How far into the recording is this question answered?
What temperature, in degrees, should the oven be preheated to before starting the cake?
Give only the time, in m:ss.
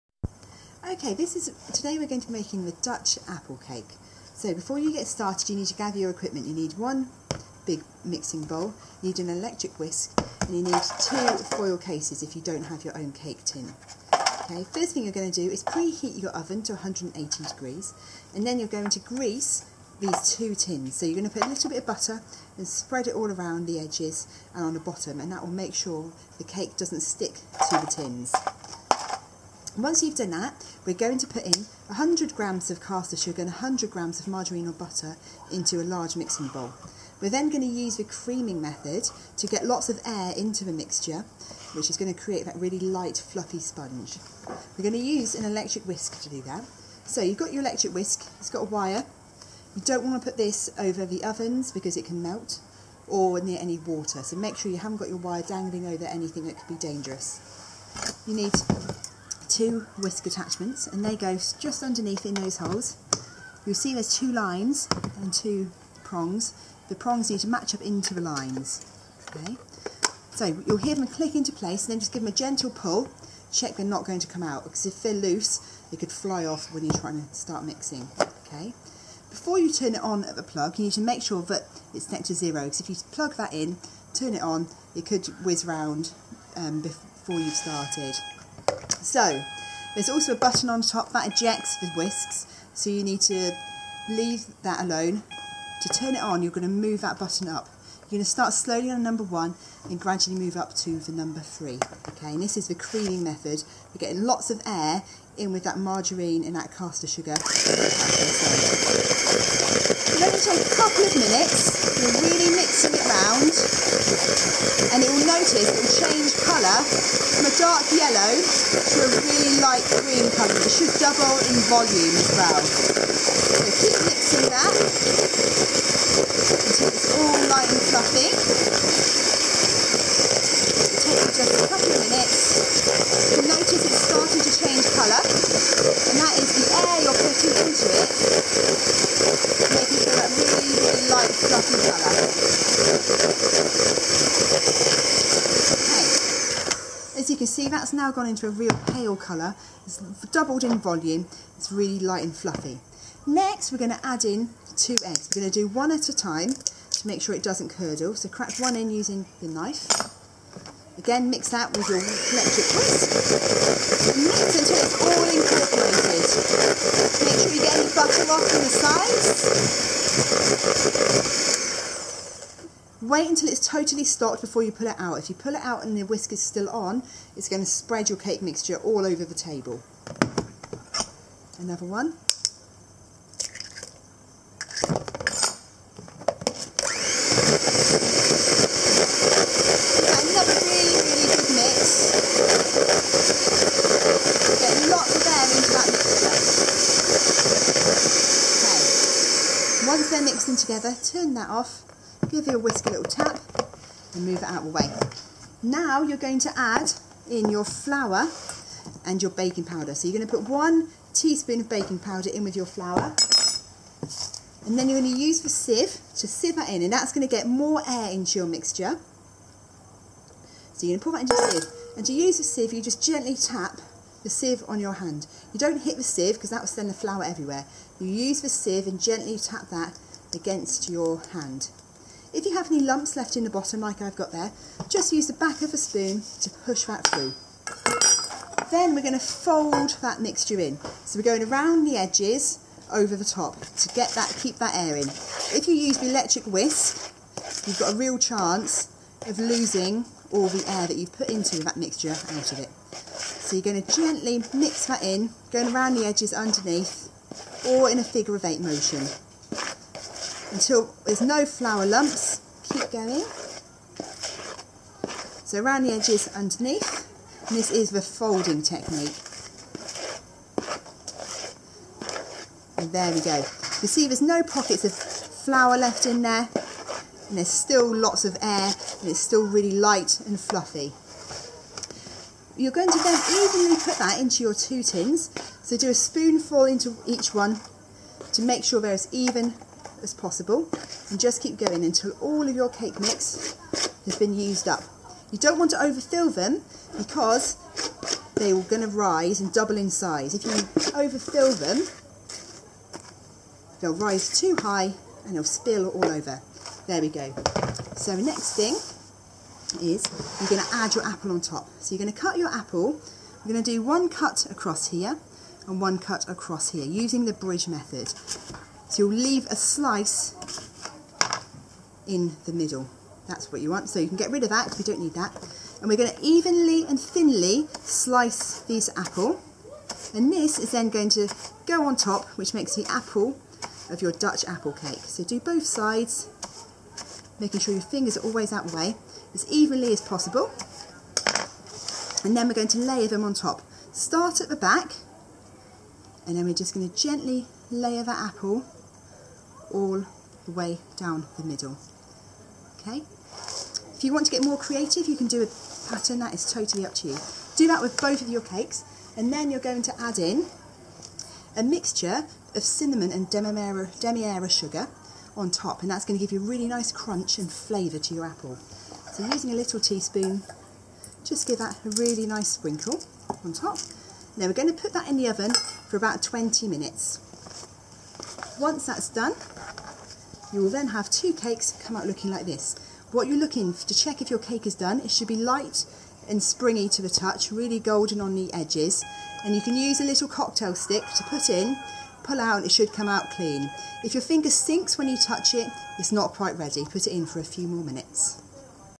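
0:16.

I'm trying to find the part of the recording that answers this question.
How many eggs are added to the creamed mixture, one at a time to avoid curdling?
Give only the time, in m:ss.
2:34.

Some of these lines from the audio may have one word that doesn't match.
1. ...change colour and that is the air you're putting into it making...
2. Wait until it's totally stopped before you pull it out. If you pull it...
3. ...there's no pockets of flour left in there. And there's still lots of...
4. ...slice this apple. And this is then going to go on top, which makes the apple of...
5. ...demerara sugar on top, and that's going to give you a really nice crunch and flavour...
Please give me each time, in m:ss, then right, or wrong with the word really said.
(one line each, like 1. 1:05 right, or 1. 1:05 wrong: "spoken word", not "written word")
1. 2:14 right
2. 2:53 right
3. 4:34 right
4. 5:27 right
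5. 6:03 right.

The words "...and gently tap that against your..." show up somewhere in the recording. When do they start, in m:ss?
3:48.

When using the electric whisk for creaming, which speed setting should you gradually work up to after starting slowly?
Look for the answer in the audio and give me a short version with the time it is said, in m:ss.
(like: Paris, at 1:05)
3, at 1:41.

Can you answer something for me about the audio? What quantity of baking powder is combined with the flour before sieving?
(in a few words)
1 teaspoon.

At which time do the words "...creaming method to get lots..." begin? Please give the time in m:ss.
0:38.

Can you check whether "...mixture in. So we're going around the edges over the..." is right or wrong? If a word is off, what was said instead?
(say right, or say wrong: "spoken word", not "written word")
right.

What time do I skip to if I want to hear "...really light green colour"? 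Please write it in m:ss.
1:59.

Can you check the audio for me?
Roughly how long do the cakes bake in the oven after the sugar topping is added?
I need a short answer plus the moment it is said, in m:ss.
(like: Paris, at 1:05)
20 minutes, at 6:15.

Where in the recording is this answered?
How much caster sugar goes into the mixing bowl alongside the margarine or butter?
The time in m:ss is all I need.
0:31.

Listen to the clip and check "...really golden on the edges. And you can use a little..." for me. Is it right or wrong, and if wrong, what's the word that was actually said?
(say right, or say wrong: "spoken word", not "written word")
right.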